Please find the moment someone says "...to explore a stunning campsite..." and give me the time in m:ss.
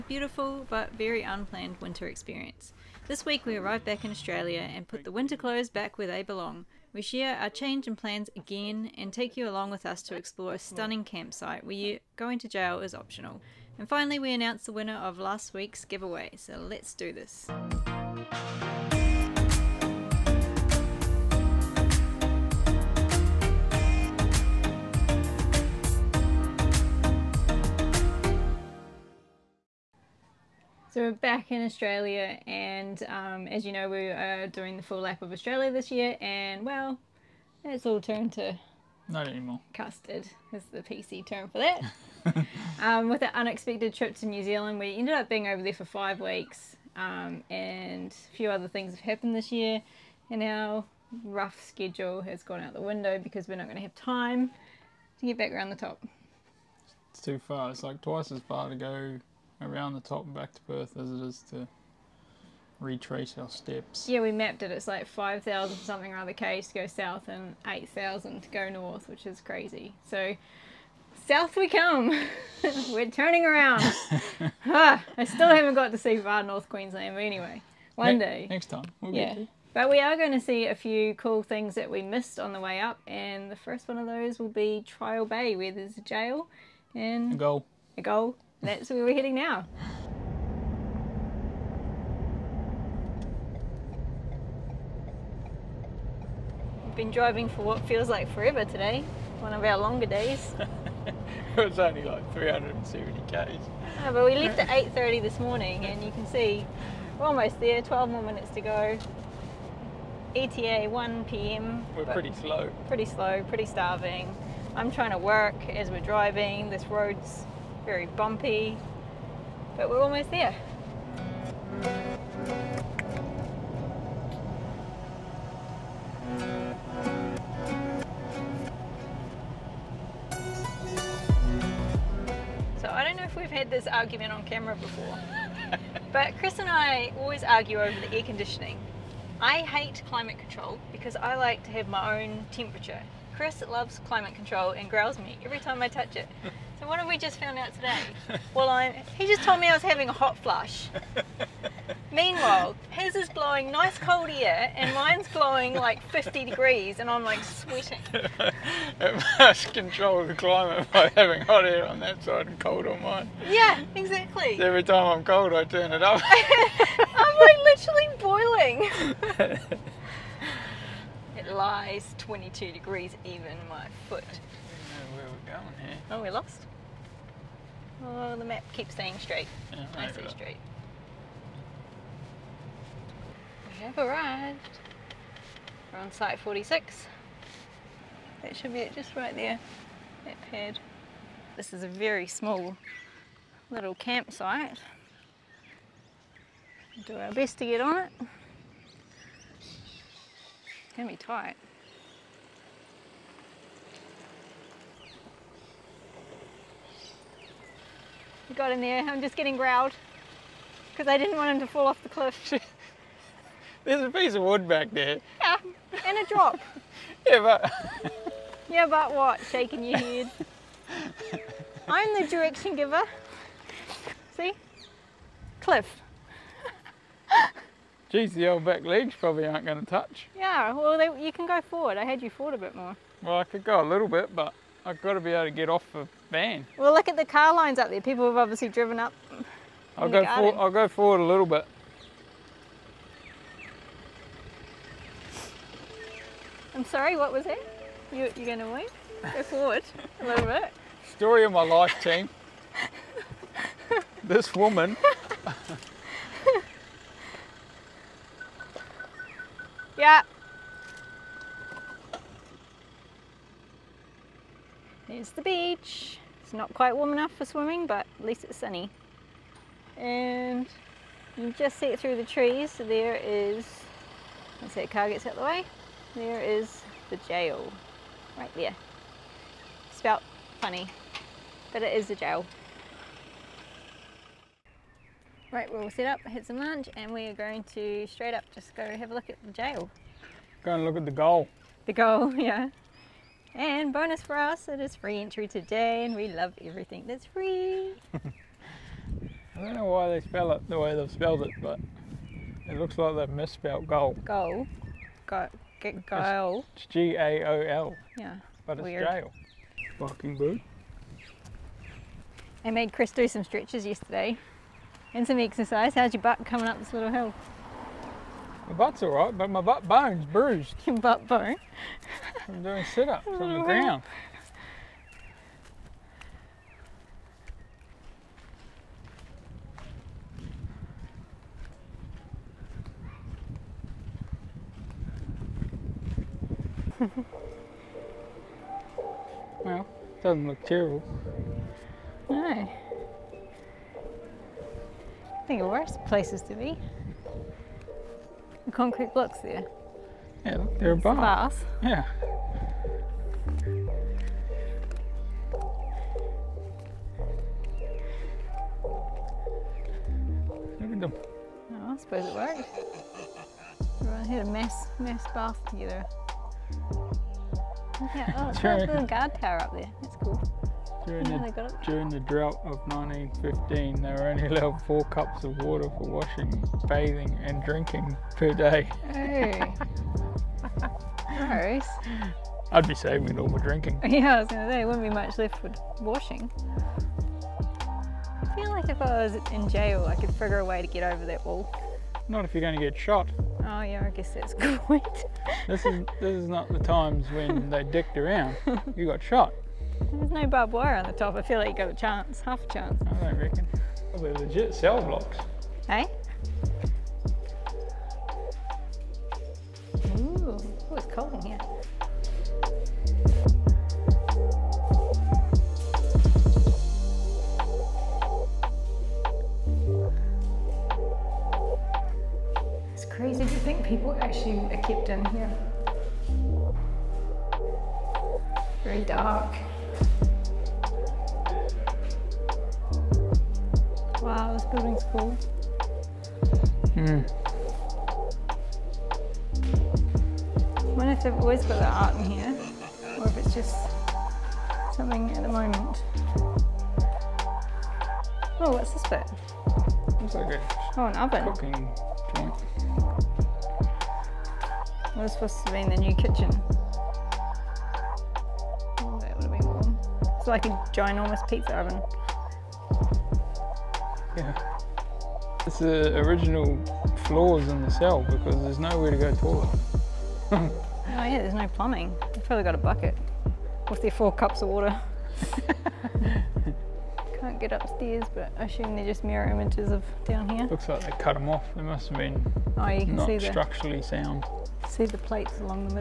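0:10.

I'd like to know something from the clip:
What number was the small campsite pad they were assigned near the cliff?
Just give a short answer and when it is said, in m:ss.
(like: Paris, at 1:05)
46, at 3:06.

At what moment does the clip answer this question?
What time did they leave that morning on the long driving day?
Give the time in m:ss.
1:44.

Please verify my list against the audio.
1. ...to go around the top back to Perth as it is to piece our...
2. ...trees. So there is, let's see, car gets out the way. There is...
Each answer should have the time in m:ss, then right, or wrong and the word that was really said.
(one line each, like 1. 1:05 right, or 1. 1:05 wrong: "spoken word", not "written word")
1. 0:58 wrong: "retrace", not "piece"
2. 4:32 right.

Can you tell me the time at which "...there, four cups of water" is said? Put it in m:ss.
7:54.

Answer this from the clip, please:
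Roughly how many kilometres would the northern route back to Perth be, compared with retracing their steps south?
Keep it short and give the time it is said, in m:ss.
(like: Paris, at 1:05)
8,000, at 1:07.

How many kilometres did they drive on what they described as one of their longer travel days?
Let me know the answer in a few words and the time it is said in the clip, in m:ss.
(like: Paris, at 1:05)
370, at 1:42.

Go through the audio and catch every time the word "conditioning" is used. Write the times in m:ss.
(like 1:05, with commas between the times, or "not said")
2:18.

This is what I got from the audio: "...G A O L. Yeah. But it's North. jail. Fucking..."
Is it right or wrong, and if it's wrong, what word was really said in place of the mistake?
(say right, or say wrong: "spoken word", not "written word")
wrong: "Weird", not "North".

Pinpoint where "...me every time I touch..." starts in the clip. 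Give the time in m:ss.
2:25.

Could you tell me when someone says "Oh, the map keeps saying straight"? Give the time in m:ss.
2:58.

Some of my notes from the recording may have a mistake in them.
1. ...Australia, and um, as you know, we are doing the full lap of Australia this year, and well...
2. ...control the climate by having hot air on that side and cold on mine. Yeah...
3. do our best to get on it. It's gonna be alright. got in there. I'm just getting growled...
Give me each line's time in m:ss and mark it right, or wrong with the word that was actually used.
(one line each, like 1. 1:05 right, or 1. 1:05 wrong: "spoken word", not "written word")
1. 0:31 right
2. 2:39 right
3. 3:17 wrong: "tight", not "alright".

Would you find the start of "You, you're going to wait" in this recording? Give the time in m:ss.
4:08.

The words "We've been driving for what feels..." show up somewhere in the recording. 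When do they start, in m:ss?
1:36.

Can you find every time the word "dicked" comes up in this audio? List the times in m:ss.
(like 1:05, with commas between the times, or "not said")
6:37.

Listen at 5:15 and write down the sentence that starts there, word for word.
How's your butt coming up this little hill?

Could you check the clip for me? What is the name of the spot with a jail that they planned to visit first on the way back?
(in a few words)
Trial Bay.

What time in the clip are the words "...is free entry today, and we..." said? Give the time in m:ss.
4:54.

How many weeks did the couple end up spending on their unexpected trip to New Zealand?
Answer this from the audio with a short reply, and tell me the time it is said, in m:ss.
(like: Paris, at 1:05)
5, at 0:45.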